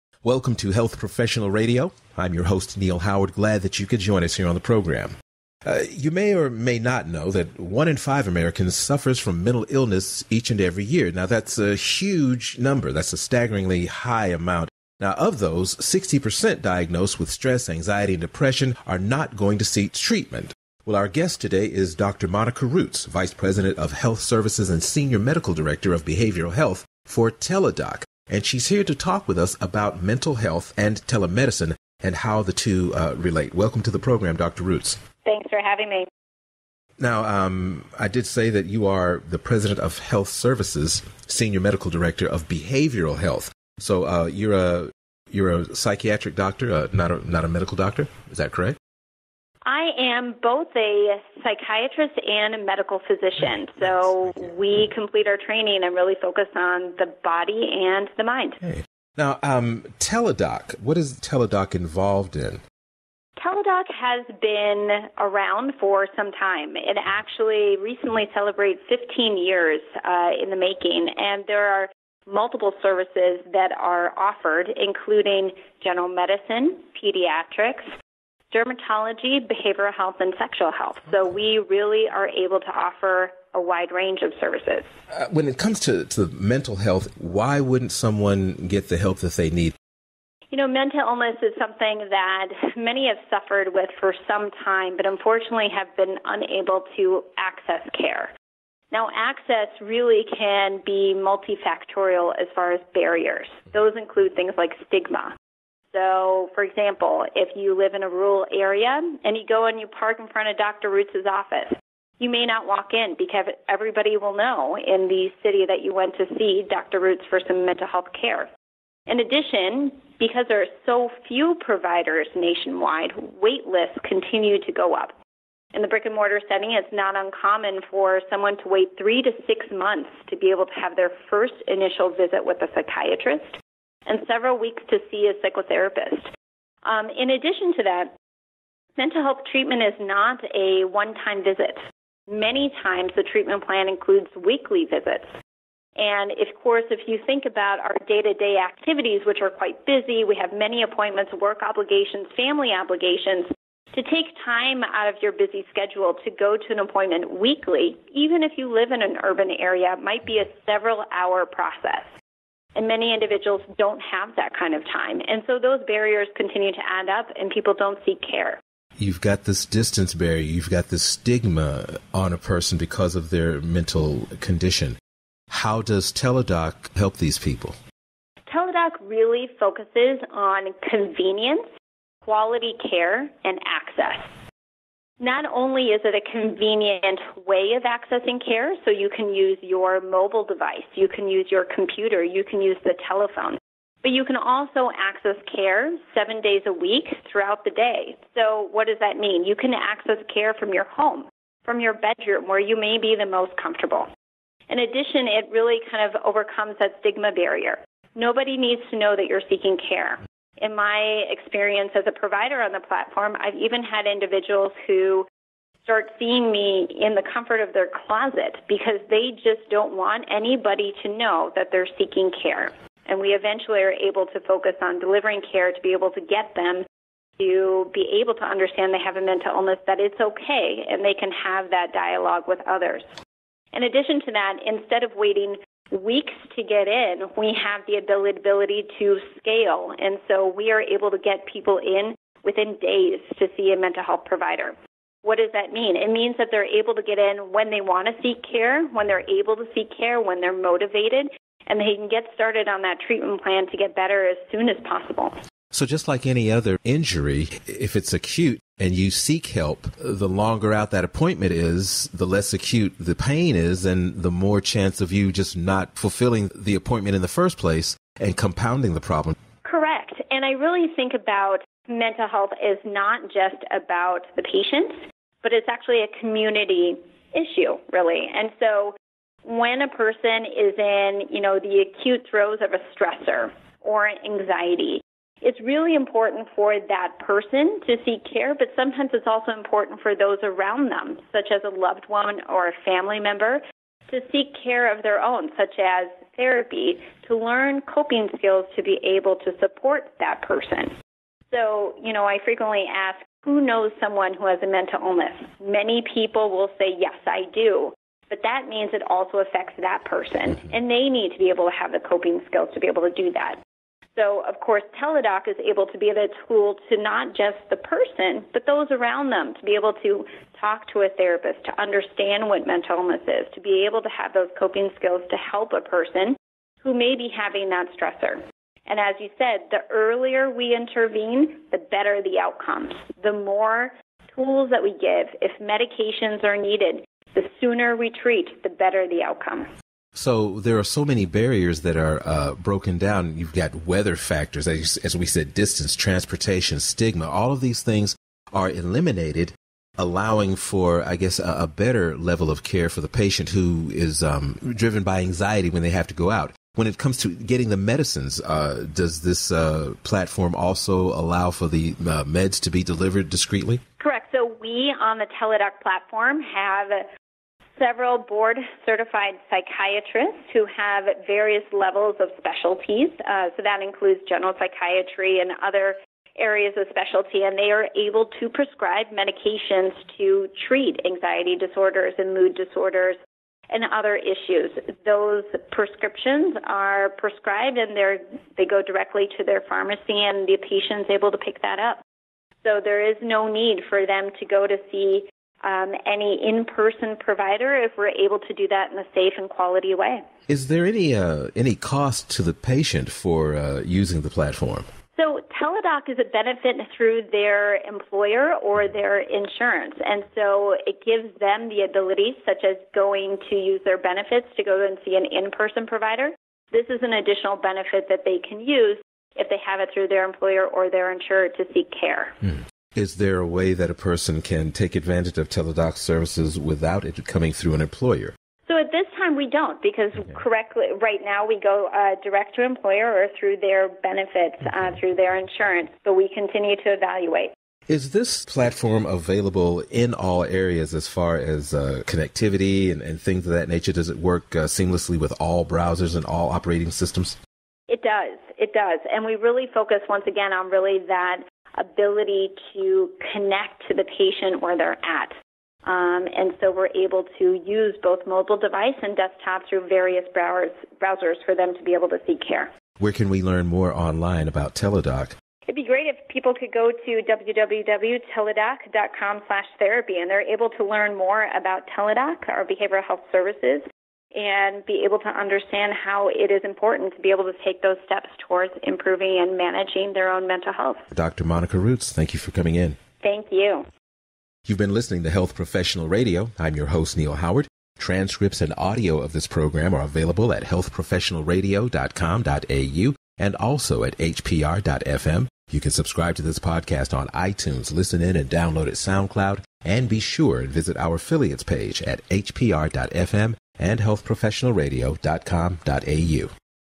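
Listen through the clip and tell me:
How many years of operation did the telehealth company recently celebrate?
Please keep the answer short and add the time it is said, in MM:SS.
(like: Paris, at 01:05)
15 years, at 01:08.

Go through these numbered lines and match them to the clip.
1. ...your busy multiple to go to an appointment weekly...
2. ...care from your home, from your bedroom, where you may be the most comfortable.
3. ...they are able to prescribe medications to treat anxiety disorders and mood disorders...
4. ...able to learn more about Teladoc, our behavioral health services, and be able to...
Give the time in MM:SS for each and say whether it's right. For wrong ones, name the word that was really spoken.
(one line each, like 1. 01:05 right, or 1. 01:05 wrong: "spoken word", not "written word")
1. 02:35 wrong: "schedule", not "multiple"
2. 03:20 right
3. 06:17 right
4. 07:50 right.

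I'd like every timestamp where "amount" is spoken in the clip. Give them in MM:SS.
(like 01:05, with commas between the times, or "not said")
00:14.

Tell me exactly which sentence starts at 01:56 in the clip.
Roots for some mental health care.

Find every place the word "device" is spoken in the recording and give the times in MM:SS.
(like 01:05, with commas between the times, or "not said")
03:10, 07:38.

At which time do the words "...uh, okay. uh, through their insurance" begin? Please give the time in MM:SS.
07:14.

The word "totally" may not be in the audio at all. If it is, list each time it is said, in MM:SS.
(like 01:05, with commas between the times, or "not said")
not said.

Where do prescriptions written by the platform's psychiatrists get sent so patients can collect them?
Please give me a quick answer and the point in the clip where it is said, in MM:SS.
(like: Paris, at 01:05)
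Their pharmacy, at 06:29.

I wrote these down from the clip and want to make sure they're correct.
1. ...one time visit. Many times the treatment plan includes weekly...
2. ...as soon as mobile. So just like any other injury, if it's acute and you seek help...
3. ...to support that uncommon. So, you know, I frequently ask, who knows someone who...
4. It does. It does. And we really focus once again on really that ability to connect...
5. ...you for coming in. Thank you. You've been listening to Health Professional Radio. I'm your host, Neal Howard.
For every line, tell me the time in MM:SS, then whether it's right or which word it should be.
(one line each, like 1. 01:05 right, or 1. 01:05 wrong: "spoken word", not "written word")
1. 02:20 right
2. 04:14 wrong: "possible", not "mobile"
3. 04:59 wrong: "person", not "uncommon"
4. 07:27 right
5. 08:02 right.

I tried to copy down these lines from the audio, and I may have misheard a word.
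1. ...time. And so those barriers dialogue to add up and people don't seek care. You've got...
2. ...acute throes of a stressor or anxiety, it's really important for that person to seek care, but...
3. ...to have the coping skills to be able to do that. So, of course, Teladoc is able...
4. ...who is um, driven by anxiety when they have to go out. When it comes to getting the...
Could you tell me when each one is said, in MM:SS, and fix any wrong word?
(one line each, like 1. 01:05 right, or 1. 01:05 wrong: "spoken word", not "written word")
1. 02:44 wrong: "continue", not "dialogue"
2. 04:41 right
3. 05:11 right
4. 05:53 right.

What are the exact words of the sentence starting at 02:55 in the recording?
How does Teladoc help these people?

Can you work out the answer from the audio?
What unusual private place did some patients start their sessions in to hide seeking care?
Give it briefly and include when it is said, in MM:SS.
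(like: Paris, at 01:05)
Their closet, at 03:37.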